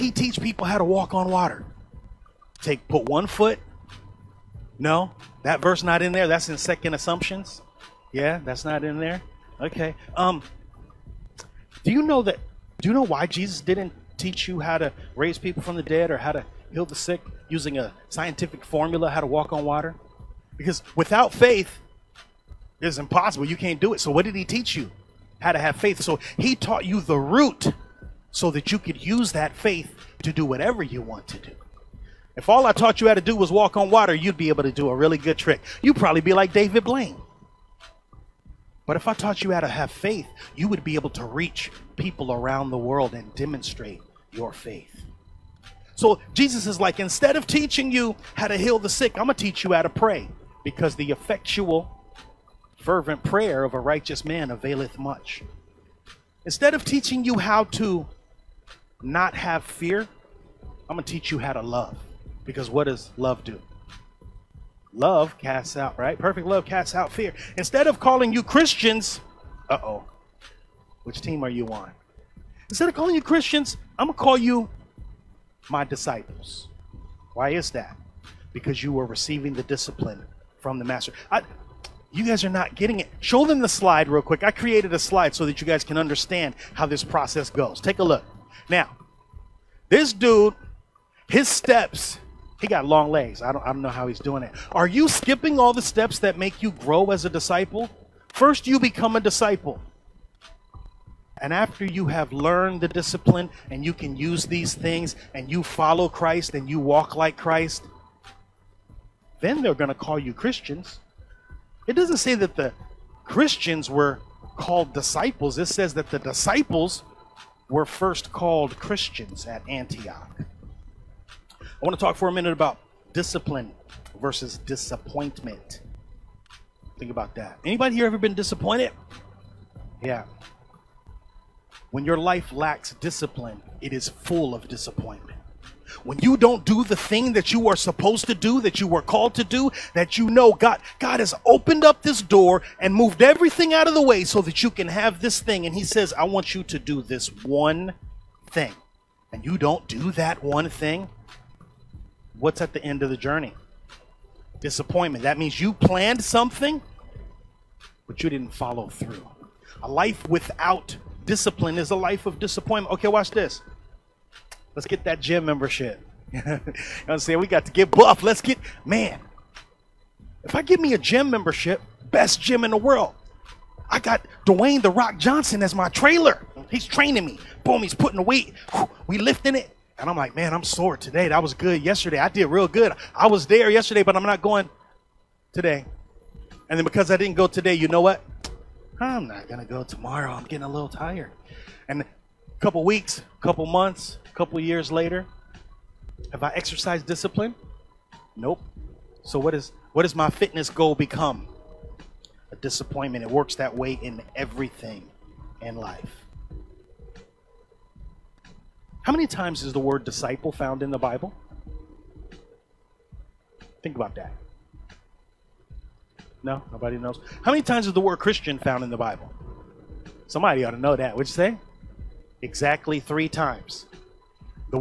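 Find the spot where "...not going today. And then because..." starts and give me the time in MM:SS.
03:04.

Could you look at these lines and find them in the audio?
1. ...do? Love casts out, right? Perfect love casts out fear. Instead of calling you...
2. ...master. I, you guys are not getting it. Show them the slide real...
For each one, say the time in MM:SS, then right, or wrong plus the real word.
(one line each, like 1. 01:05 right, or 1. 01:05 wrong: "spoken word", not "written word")
1. 01:03 right
2. 01:20 right.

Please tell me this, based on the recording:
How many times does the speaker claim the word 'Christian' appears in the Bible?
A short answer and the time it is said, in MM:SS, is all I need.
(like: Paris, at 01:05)
3, at 03:42.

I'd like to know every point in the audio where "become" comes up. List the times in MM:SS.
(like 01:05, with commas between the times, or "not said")
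01:38, 03:20.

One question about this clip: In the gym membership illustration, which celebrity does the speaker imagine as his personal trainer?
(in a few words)
Dwayne The Rock Johnson.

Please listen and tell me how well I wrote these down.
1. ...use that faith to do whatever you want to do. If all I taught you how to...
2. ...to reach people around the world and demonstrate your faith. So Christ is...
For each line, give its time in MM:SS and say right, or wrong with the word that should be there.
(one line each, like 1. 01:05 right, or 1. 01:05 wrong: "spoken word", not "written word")
1. 00:29 right
2. 00:41 wrong: "Jesus", not "Christ".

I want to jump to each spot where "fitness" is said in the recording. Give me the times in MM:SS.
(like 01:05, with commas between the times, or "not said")
03:20.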